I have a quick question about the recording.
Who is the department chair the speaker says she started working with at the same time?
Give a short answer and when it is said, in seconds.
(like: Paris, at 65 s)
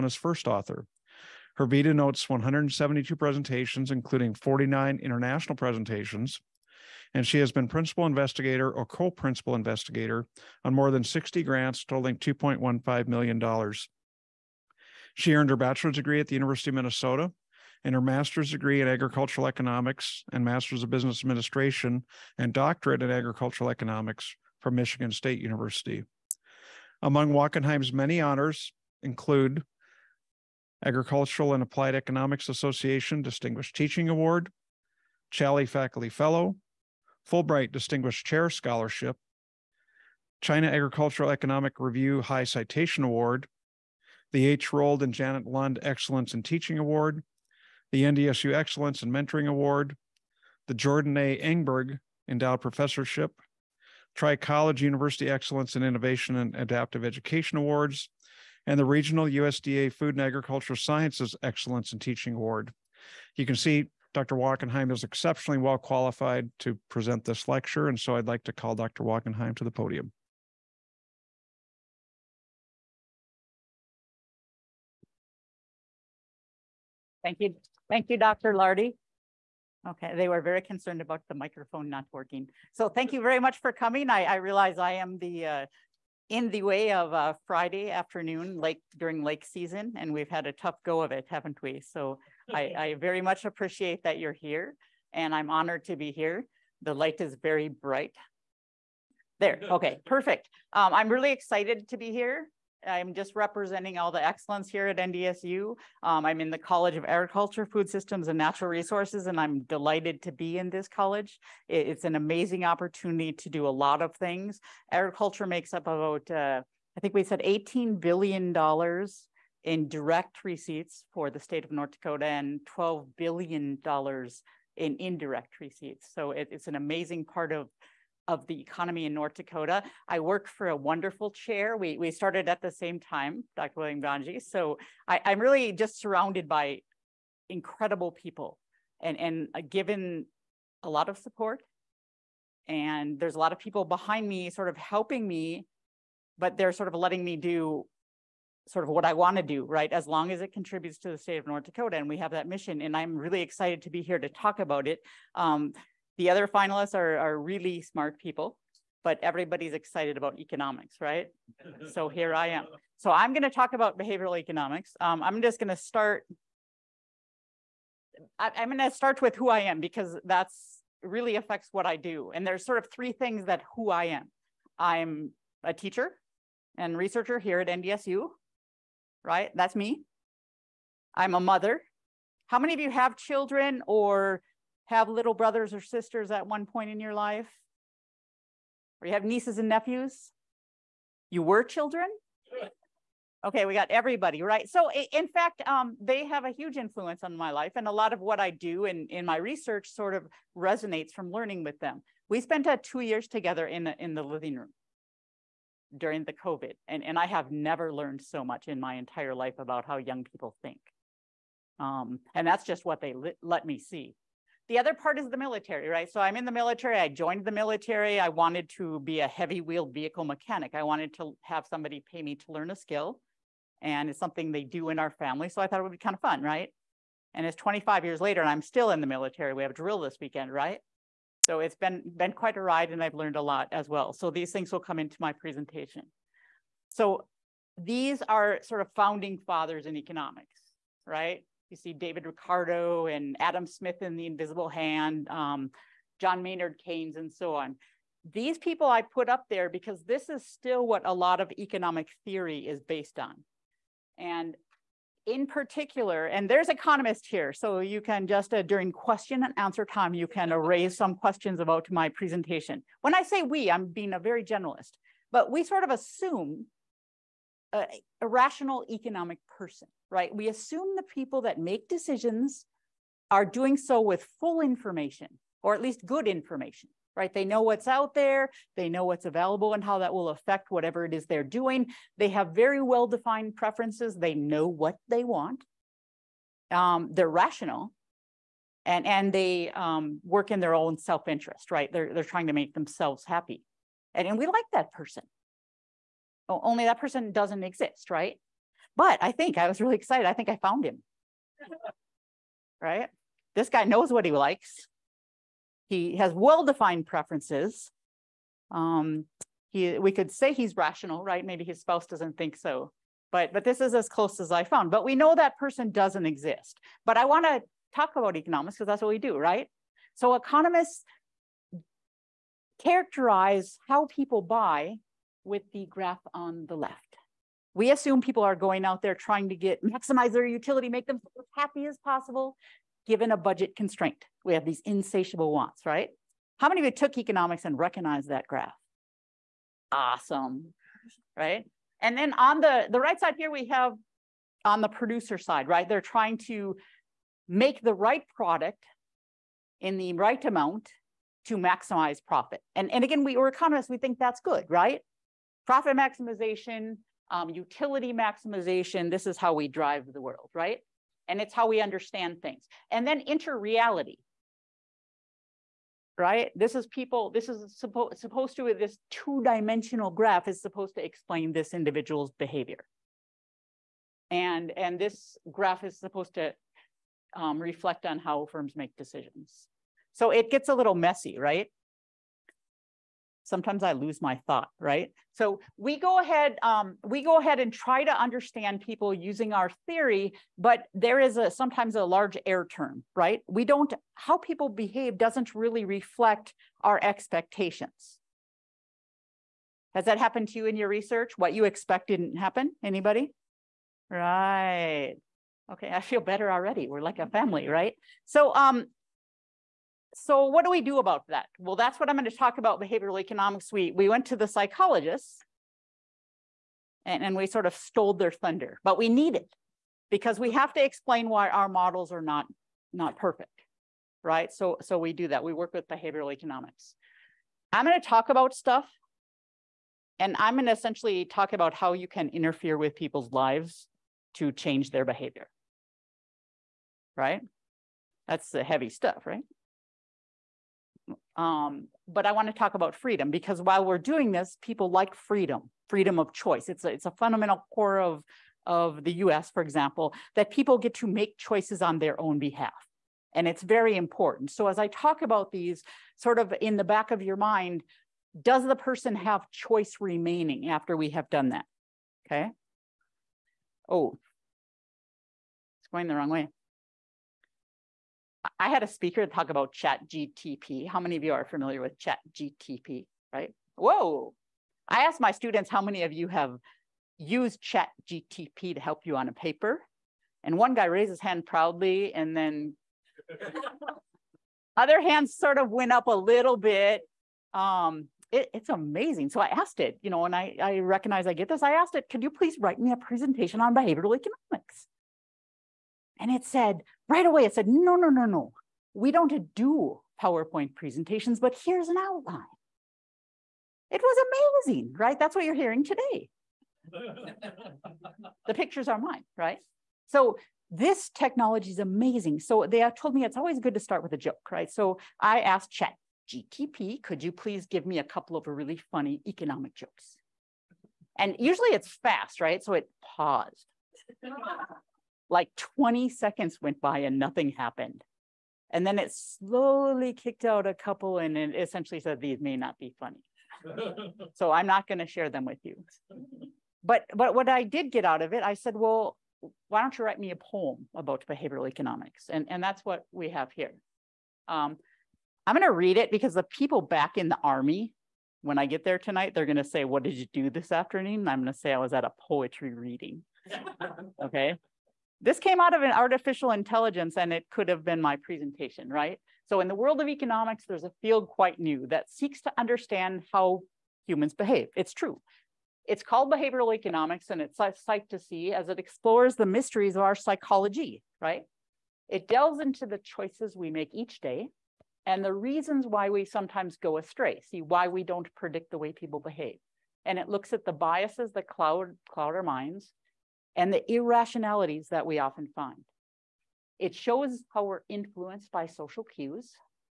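William Nganje, at 133 s.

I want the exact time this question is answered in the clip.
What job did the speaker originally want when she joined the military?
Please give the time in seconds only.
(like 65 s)
219 s.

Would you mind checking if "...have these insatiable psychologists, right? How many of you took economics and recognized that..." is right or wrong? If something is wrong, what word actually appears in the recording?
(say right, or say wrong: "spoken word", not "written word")
wrong: "wants", not "psychologists".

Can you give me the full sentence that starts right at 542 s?
And, and that's what we have here.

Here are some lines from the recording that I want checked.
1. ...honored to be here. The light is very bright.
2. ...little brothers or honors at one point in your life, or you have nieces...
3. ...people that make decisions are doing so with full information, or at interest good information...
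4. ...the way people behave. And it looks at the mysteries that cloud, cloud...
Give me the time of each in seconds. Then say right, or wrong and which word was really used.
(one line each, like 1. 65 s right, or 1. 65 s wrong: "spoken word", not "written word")
1. 95 s right
2. 185 s wrong: "sisters", not "honors"
3. 271 s wrong: "least", not "interest"
4. 578 s wrong: "biases", not "mysteries".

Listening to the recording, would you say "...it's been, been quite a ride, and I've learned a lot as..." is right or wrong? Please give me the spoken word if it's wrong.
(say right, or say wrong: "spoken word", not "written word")
right.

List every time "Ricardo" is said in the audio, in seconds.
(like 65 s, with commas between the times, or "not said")
242 s.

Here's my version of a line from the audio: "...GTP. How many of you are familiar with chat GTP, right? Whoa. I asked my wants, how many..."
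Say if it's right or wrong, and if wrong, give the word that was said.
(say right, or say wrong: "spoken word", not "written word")
wrong: "students", not "wants".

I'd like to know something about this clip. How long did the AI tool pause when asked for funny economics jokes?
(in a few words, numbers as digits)
20 seconds.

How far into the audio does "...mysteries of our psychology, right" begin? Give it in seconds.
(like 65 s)
569 s.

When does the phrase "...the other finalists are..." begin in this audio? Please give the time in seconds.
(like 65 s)
156 s.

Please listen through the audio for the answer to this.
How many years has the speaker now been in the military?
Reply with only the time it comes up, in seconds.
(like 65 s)
227 s.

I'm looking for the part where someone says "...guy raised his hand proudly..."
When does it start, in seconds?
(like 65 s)
480 s.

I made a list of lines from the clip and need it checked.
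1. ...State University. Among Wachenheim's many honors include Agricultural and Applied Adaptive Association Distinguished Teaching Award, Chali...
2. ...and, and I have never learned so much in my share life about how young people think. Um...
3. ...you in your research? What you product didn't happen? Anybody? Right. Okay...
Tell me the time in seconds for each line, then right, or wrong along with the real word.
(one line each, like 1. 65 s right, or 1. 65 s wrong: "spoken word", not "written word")
1. 25 s wrong: "Economics", not "Adaptive"
2. 206 s wrong: "entire", not "share"
3. 400 s wrong: "expect", not "product".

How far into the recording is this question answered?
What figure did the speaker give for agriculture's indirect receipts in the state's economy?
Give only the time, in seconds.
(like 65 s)
122 s.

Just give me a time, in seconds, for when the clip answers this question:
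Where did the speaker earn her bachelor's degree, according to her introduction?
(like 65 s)
16 s.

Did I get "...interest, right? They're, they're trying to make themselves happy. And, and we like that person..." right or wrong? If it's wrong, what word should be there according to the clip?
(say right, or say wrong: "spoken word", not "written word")
right.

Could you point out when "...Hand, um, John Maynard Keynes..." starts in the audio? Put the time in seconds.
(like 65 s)
244 s.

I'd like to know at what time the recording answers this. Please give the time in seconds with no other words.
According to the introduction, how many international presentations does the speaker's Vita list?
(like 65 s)
4 s.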